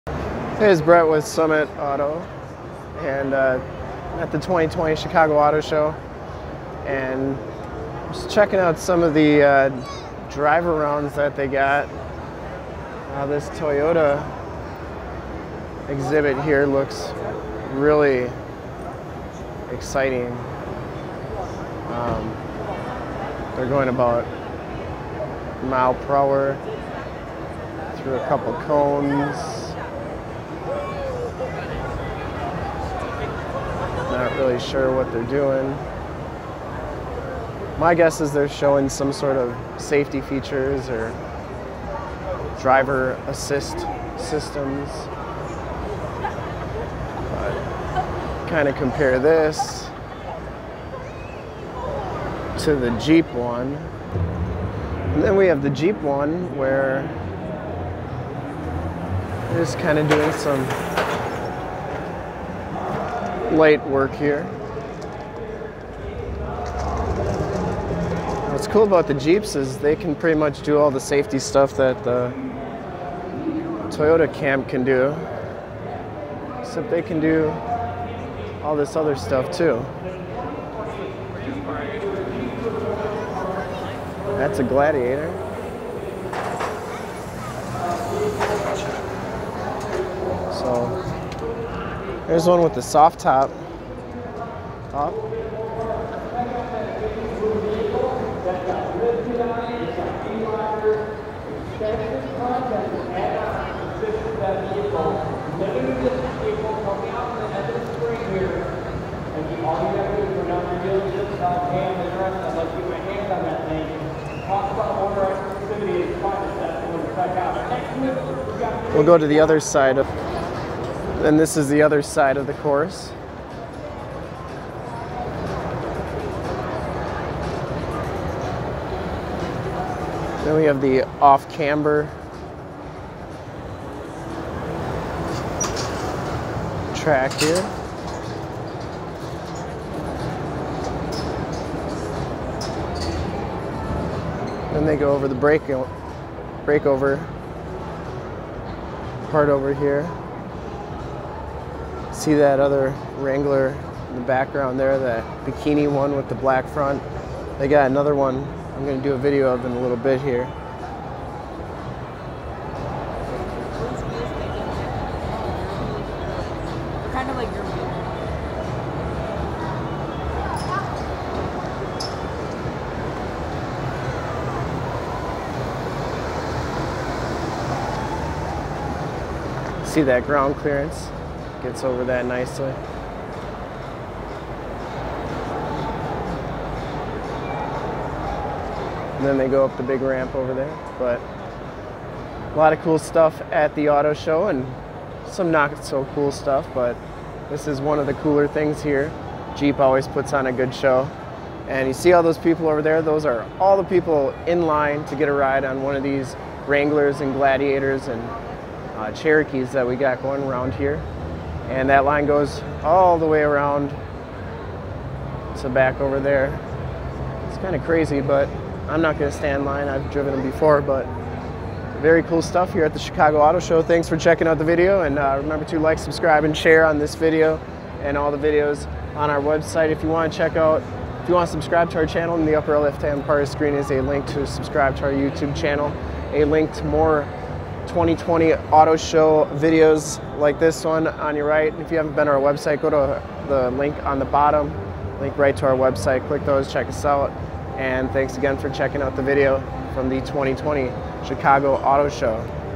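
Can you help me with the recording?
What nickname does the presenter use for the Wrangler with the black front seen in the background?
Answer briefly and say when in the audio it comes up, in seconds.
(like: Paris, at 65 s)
bikini, at 155 s.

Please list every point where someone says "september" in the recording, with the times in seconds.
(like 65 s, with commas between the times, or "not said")
not said.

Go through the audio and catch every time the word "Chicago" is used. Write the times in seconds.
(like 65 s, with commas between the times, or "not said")
4 s, 222 s, 251 s.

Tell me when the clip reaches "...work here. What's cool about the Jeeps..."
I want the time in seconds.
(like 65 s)
63 s.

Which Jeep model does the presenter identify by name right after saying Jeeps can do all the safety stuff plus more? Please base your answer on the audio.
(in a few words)
Gladiator.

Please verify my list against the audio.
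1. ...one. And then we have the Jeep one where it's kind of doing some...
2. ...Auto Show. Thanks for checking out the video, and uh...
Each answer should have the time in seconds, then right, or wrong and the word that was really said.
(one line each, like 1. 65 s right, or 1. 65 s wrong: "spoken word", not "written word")
1. 53 s right
2. 223 s right.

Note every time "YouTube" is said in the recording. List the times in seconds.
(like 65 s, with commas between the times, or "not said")
235 s.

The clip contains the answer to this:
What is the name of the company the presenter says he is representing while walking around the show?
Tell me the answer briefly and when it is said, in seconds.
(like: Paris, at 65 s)
Summit Auto, at 1 s.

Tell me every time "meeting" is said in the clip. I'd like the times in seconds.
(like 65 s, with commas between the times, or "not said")
not said.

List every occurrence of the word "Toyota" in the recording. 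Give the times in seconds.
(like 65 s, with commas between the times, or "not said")
13 s, 73 s.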